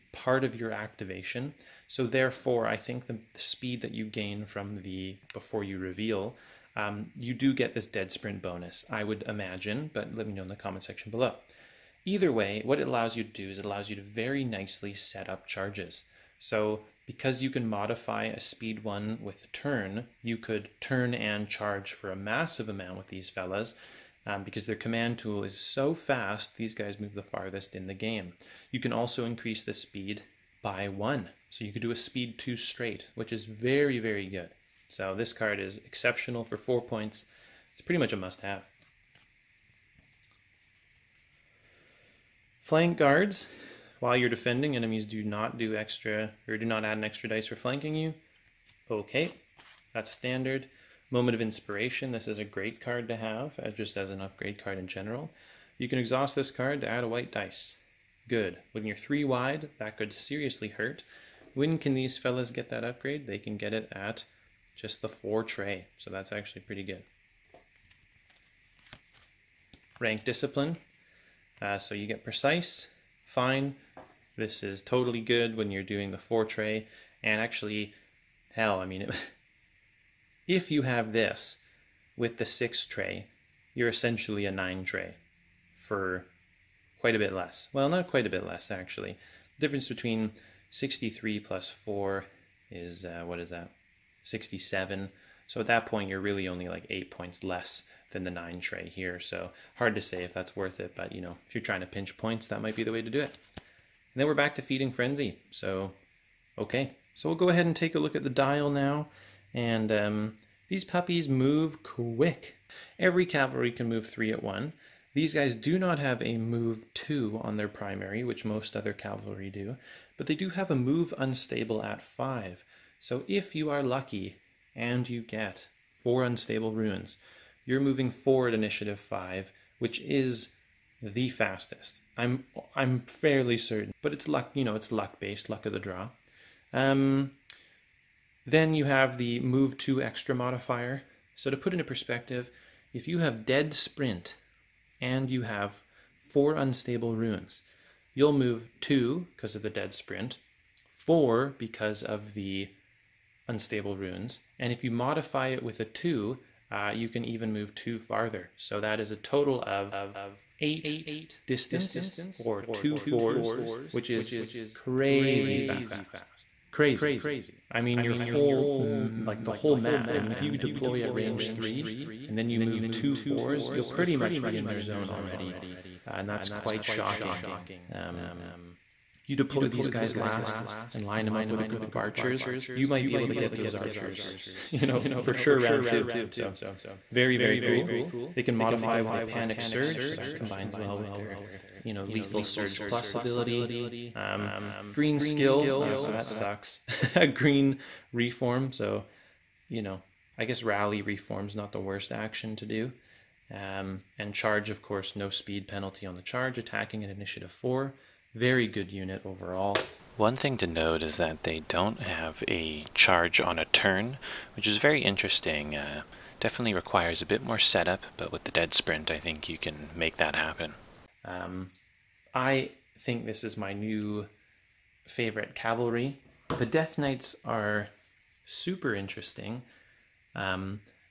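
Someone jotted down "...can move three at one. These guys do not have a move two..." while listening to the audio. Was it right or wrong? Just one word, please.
right.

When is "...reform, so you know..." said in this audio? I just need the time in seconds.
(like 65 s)
198 s.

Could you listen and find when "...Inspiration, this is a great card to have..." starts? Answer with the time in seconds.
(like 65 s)
51 s.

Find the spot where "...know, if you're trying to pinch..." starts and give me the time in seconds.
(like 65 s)
101 s.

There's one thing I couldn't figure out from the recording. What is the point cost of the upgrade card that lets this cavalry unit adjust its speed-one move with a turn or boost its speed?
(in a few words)
4 points.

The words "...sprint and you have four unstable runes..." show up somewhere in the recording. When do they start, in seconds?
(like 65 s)
143 s.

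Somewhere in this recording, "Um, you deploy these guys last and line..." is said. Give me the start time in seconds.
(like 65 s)
177 s.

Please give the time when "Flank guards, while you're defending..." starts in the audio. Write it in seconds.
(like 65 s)
42 s.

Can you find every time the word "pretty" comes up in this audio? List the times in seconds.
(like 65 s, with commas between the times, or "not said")
37 s, 66 s, 173 s.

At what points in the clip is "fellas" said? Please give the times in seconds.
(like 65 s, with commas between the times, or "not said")
23 s, 62 s.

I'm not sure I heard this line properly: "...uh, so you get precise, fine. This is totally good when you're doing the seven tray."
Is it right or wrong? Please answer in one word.
wrong.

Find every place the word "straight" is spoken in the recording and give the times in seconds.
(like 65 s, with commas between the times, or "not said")
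32 s.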